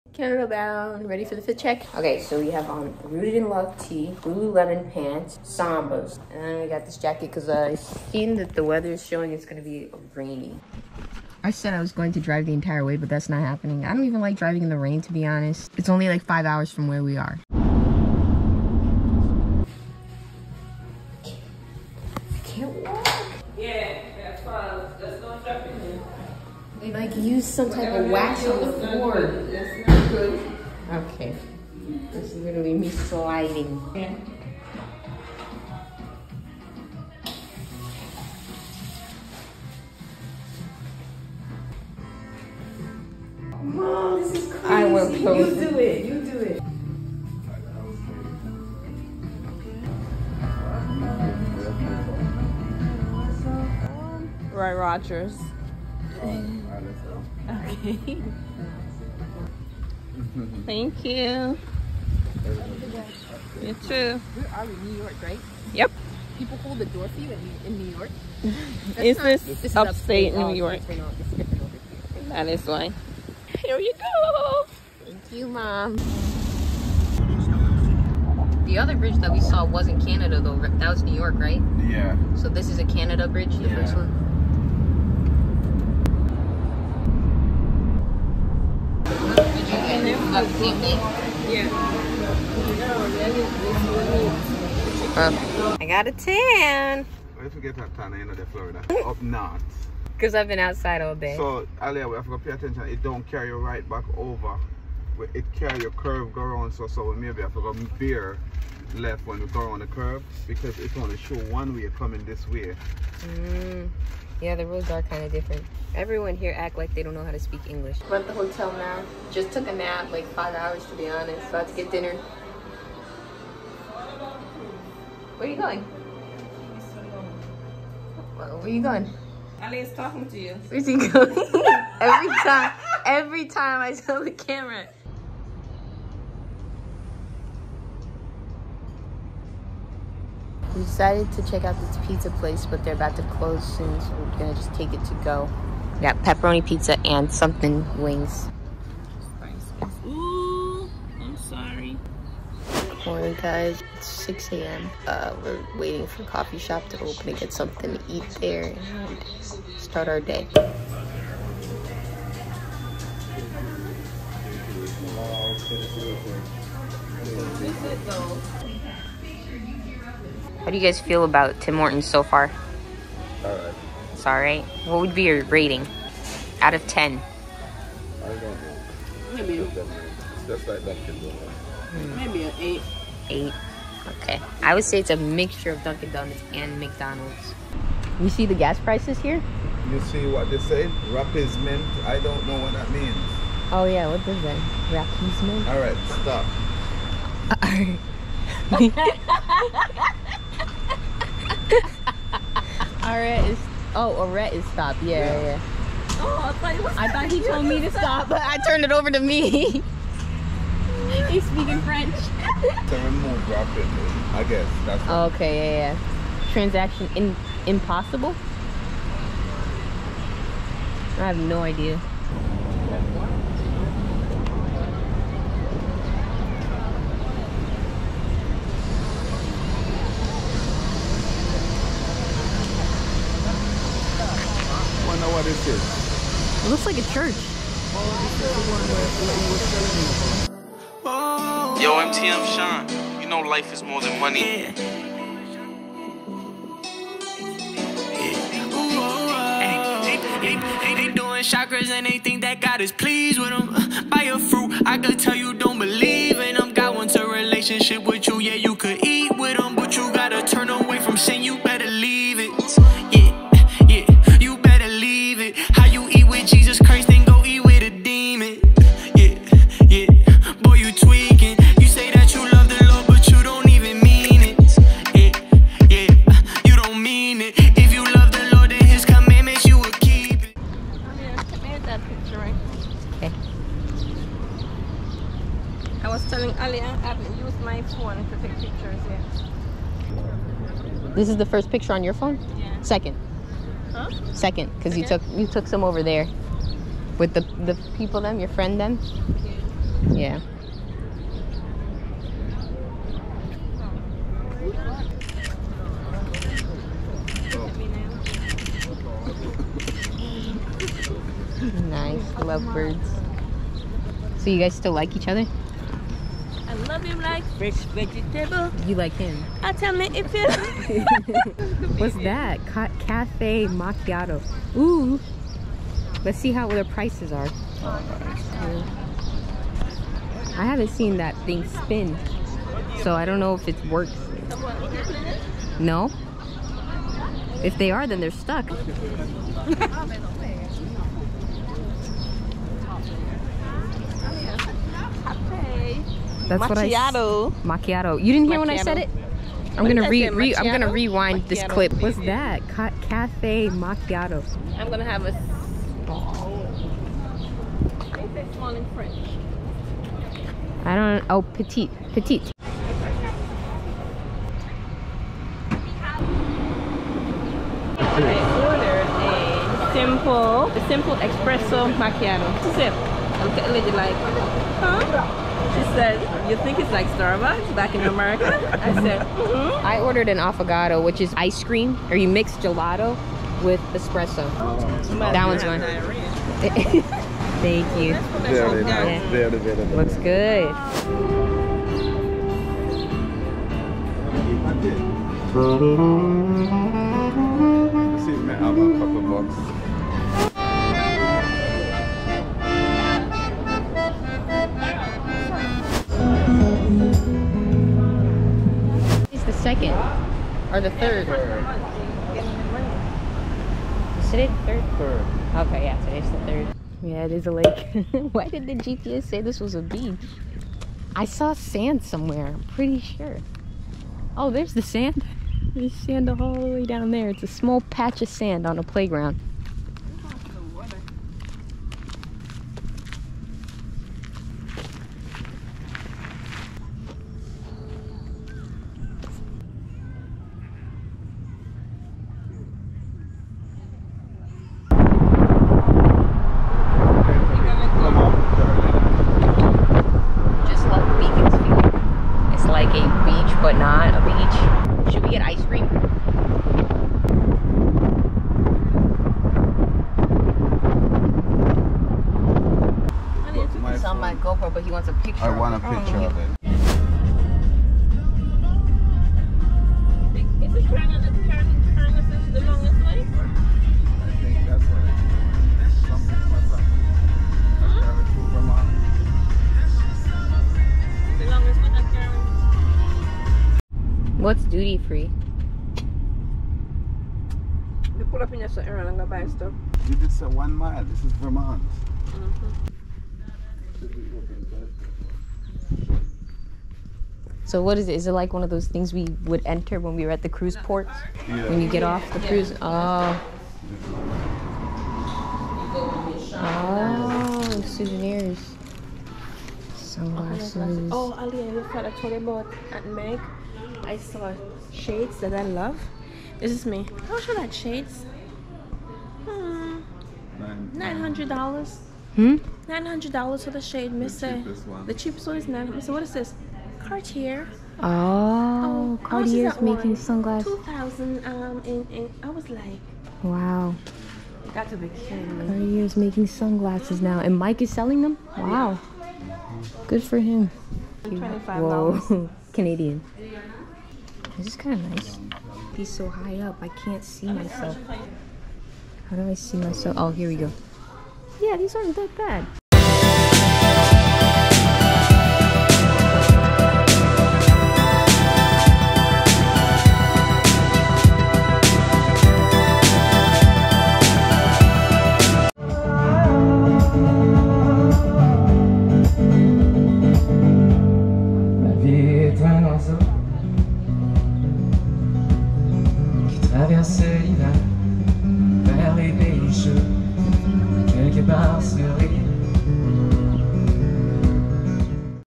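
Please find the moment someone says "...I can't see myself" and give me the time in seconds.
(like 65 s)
546 s.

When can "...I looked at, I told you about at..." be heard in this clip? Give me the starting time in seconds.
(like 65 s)
511 s.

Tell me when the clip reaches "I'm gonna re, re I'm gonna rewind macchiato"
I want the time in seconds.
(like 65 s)
349 s.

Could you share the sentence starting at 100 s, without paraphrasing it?
Because I've been outside all day.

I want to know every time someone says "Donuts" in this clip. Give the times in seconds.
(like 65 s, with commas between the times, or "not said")
181 s, 186 s.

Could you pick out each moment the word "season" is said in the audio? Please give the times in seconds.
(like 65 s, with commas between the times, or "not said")
not said.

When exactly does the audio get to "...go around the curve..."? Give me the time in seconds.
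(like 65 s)
109 s.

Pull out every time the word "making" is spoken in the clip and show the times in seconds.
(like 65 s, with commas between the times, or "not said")
529 s, 536 s.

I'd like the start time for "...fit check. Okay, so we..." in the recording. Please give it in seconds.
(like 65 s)
1 s.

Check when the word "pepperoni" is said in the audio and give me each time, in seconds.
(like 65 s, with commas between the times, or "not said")
146 s.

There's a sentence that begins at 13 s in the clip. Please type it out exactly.
I don't even like driving in the rain, to be honest.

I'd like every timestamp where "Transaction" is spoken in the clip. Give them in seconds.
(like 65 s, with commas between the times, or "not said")
216 s.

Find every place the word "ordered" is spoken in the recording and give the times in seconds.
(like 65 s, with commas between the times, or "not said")
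368 s, 380 s.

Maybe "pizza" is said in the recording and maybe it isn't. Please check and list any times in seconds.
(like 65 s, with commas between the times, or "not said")
142 s, 146 s.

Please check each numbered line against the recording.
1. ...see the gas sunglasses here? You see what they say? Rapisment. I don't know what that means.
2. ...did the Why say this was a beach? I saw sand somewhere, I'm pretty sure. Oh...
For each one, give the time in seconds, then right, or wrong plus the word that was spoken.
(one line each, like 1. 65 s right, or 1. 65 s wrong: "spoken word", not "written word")
1. 188 s wrong: "prices", not "sunglasses"
2. 418 s wrong: "GPS", not "Why".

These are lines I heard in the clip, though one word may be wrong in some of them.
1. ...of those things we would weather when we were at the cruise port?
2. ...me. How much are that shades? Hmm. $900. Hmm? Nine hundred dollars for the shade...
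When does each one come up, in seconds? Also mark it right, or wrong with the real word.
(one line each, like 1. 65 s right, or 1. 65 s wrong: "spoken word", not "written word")
1. 498 s wrong: "enter", not "weather"
2. 516 s right.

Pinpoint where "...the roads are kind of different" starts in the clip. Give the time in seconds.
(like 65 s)
114 s.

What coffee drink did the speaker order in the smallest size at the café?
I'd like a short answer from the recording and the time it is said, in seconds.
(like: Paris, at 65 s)
espresso macchiato, at 371 s.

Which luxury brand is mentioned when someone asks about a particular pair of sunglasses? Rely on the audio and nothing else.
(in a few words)
Cartier.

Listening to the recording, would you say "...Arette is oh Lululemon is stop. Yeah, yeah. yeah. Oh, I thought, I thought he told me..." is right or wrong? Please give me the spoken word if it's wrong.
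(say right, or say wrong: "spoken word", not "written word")
wrong: "Arette", not "Lululemon".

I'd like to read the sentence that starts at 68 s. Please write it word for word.
is this, this upstate, upstate New York?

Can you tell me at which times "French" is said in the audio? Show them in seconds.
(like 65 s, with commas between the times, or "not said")
211 s, 358 s.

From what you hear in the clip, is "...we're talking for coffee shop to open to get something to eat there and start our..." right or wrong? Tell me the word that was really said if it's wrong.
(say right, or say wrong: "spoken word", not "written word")
wrong: "waiting", not "talking".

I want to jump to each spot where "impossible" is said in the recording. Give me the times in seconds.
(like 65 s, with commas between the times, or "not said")
217 s.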